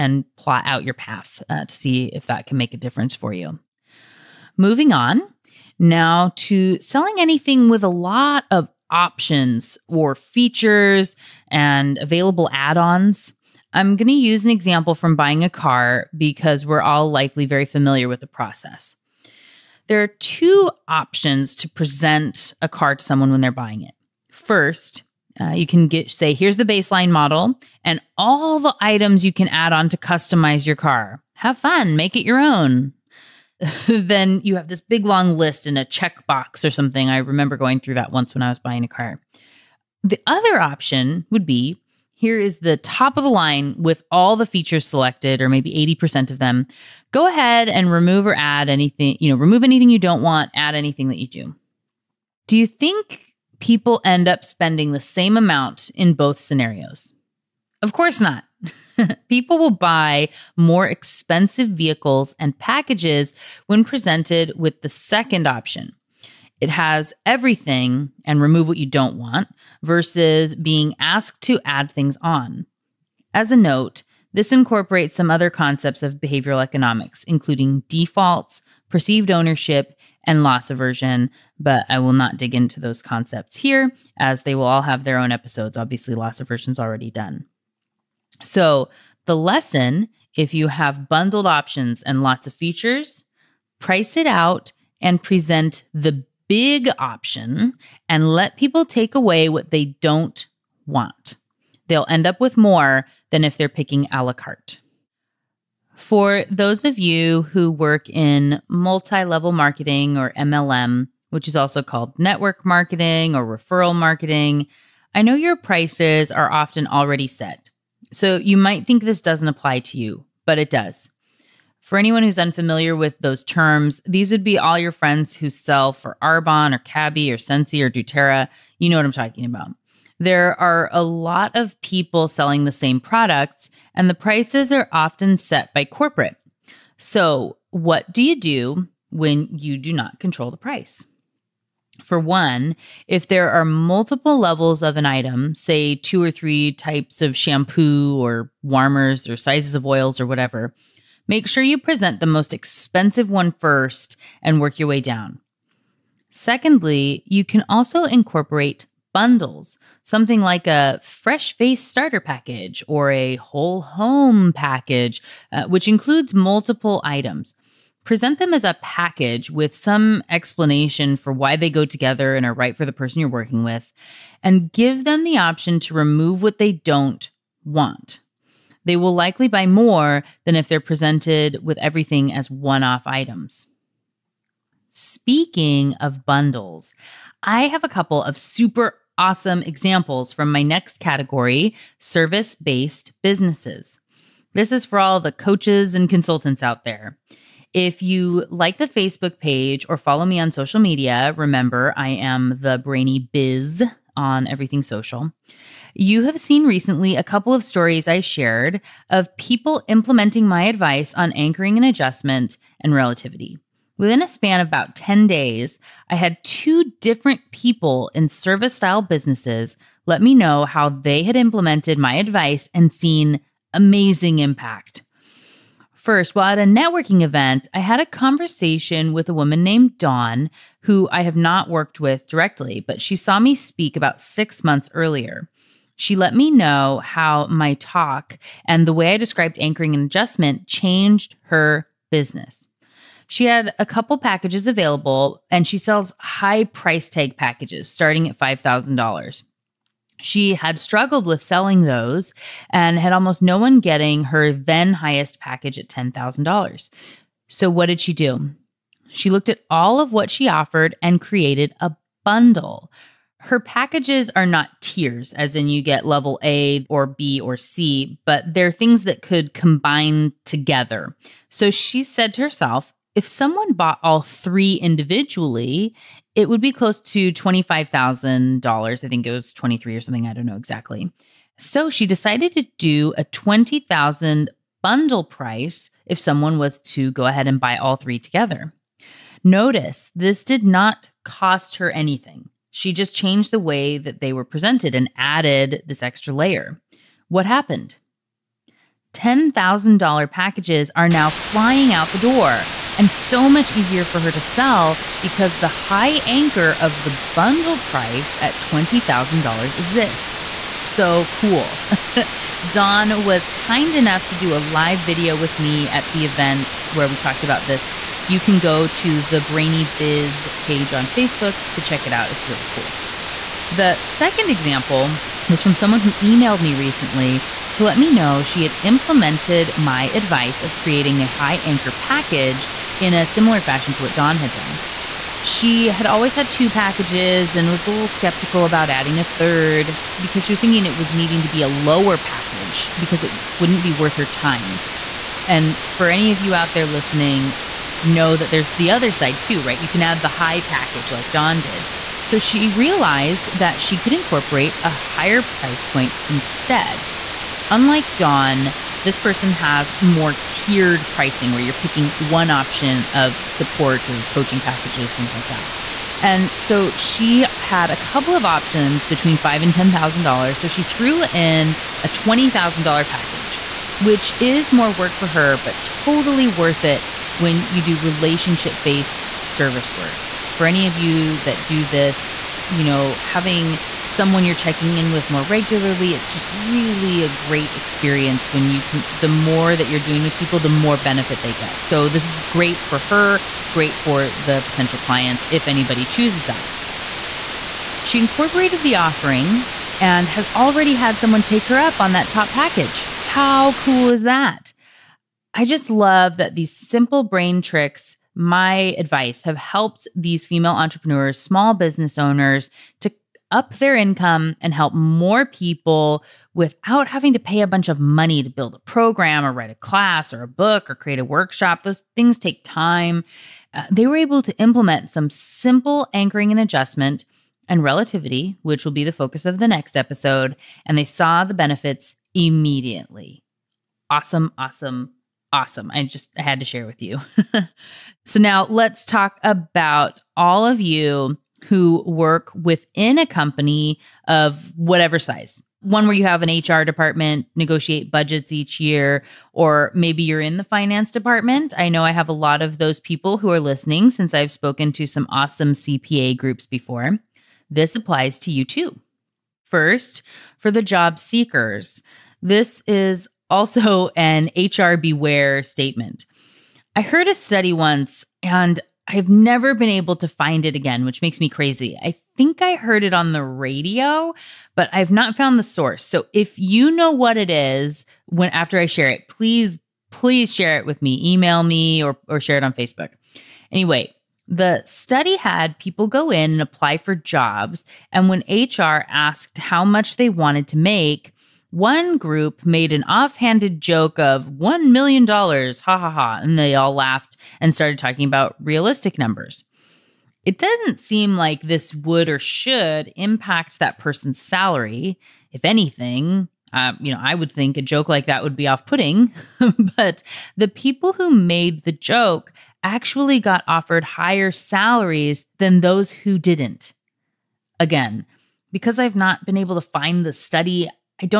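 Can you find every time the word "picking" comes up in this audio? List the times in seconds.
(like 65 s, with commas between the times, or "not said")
103 s, 361 s.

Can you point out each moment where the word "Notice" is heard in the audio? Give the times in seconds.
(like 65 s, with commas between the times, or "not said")
289 s.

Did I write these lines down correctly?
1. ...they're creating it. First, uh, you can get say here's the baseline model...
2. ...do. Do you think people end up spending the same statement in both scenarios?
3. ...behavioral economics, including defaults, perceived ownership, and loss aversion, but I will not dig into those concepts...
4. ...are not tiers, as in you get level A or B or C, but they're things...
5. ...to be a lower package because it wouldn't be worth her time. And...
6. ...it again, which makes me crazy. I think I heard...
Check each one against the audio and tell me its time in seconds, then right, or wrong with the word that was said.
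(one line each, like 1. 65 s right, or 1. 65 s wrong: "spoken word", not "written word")
1. 23 s wrong: "buying", not "creating"
2. 51 s wrong: "amount", not "statement"
3. 76 s right
4. 264 s right
5. 341 s right
6. 470 s right.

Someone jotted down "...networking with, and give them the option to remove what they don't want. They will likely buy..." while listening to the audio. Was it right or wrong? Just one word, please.
wrong.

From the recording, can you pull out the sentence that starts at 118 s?
So you might think this doesn't apply to you, but it does.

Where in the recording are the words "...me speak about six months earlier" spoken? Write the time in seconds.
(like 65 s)
233 s.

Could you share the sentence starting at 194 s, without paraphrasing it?
This is for all the coaches and consultants out there.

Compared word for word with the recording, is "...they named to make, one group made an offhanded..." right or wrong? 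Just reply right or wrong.
wrong.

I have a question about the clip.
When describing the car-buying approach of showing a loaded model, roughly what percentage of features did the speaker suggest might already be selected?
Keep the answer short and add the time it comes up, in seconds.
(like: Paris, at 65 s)
80%, at 45 s.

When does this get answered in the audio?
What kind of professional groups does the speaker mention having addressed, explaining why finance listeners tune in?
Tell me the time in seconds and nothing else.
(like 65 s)
455 s.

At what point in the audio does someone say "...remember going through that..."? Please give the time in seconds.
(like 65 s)
37 s.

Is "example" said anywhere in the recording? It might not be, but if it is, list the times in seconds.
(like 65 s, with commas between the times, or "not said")
14 s, 189 s, 324 s.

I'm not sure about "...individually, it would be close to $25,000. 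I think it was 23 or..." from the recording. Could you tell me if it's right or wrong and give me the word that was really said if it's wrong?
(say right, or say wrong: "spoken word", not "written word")
right.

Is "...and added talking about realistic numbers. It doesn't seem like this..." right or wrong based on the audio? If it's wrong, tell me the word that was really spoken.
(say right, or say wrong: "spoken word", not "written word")
wrong: "started", not "added".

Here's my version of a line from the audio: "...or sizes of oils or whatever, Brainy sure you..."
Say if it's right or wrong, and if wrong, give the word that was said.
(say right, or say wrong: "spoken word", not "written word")
wrong: "Make", not "Brainy".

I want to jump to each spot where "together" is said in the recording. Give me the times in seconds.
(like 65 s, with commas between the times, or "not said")
171 s, 270 s, 288 s.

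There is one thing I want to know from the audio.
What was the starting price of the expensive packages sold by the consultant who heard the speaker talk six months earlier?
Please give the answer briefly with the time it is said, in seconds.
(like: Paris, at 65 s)
$5,000, at 248 s.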